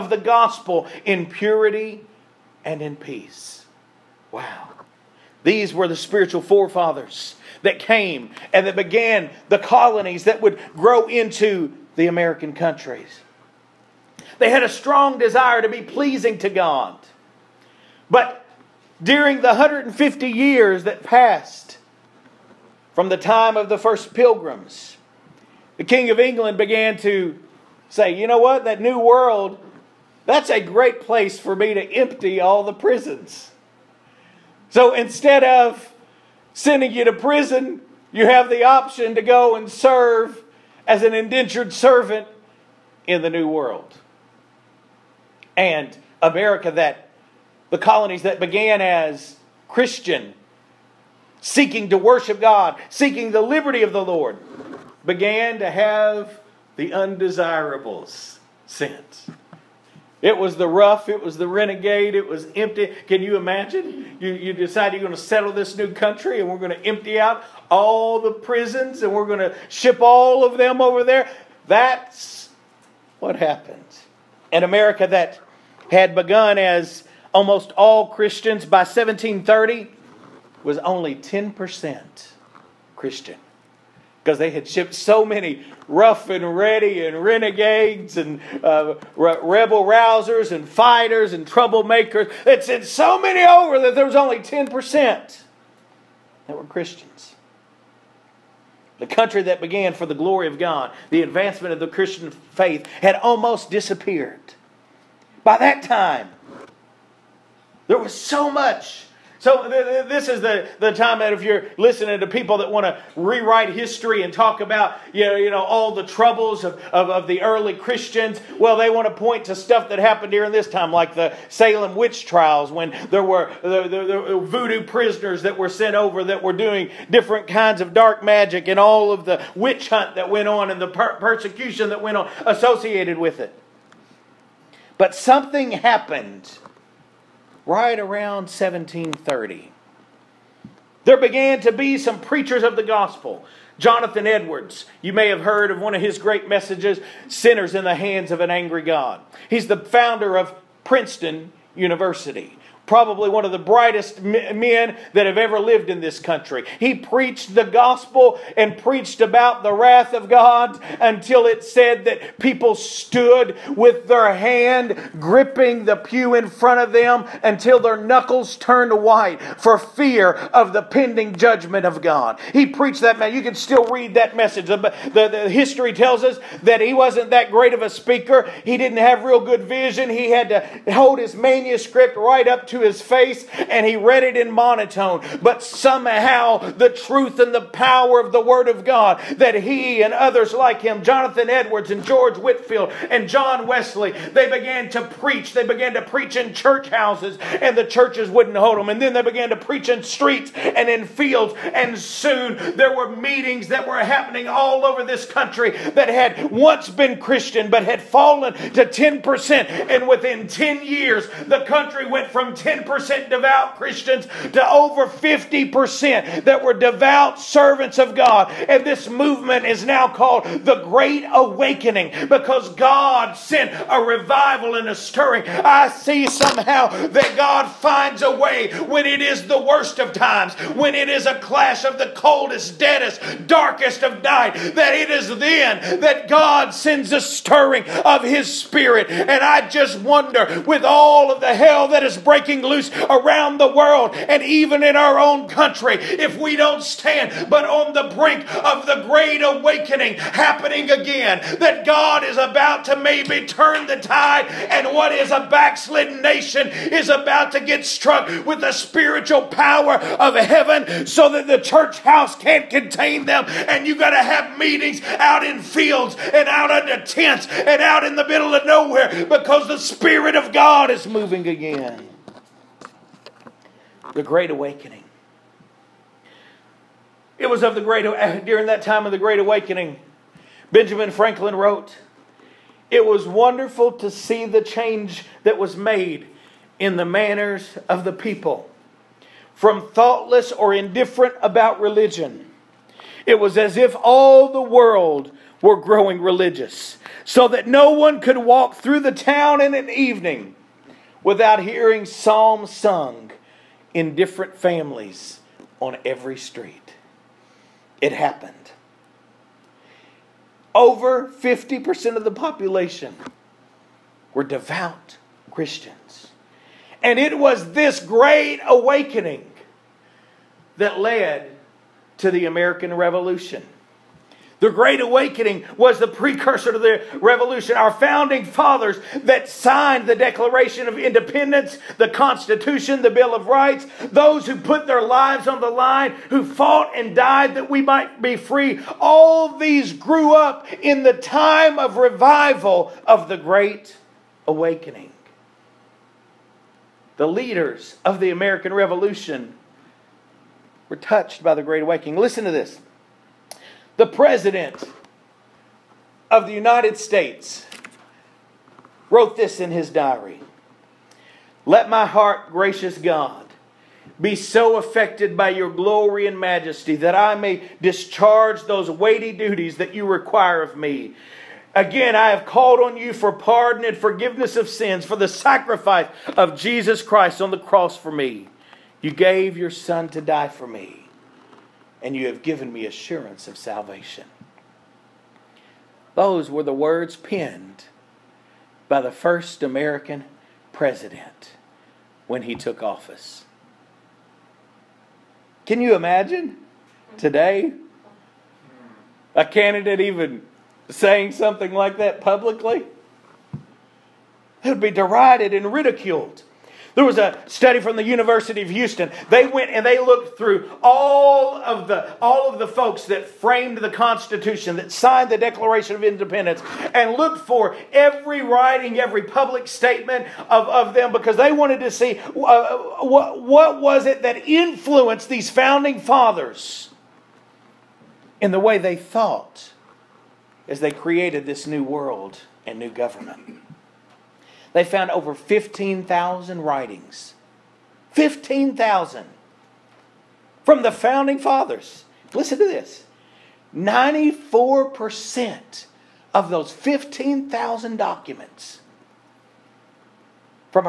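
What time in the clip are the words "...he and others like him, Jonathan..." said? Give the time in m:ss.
3:09.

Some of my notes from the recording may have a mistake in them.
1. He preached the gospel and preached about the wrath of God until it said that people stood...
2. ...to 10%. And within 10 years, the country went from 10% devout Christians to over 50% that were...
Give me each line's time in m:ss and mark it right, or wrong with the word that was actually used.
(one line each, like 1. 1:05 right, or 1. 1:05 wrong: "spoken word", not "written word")
1. 2:36 right
2. 3:28 right.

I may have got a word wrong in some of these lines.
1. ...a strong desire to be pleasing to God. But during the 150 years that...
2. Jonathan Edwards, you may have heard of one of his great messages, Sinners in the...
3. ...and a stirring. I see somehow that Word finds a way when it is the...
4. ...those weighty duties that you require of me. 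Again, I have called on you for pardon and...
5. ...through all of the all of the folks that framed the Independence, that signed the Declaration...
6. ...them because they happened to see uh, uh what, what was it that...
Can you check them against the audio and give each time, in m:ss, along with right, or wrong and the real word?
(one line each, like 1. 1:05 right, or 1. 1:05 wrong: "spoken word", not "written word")
1. 0:14 right
2. 2:23 right
3. 3:44 wrong: "God", not "Word"
4. 6:08 right
5. 6:50 wrong: "Constitution", not "Independence"
6. 7:00 wrong: "wanted", not "happened".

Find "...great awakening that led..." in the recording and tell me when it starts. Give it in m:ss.
5:17.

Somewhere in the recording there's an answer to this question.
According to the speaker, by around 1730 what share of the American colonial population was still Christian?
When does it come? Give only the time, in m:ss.
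1:20.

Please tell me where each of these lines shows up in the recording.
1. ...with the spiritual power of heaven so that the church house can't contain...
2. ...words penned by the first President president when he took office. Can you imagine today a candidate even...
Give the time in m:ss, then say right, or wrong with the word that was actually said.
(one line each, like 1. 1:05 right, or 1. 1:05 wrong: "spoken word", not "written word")
1. 4:18 right
2. 6:26 wrong: "American", not "President".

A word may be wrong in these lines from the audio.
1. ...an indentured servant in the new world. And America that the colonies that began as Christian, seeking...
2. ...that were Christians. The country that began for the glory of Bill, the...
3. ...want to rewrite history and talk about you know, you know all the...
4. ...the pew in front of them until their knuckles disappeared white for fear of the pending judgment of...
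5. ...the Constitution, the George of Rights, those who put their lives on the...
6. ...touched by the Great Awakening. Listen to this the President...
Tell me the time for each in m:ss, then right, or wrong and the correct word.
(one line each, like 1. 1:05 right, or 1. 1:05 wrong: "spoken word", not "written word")
1. 0:41 right
2. 1:36 wrong: "God", not "Bill"
3. 1:52 right
4. 2:45 wrong: "turned", not "disappeared"
5. 5:31 wrong: "Bill", not "George"
6. 5:50 right.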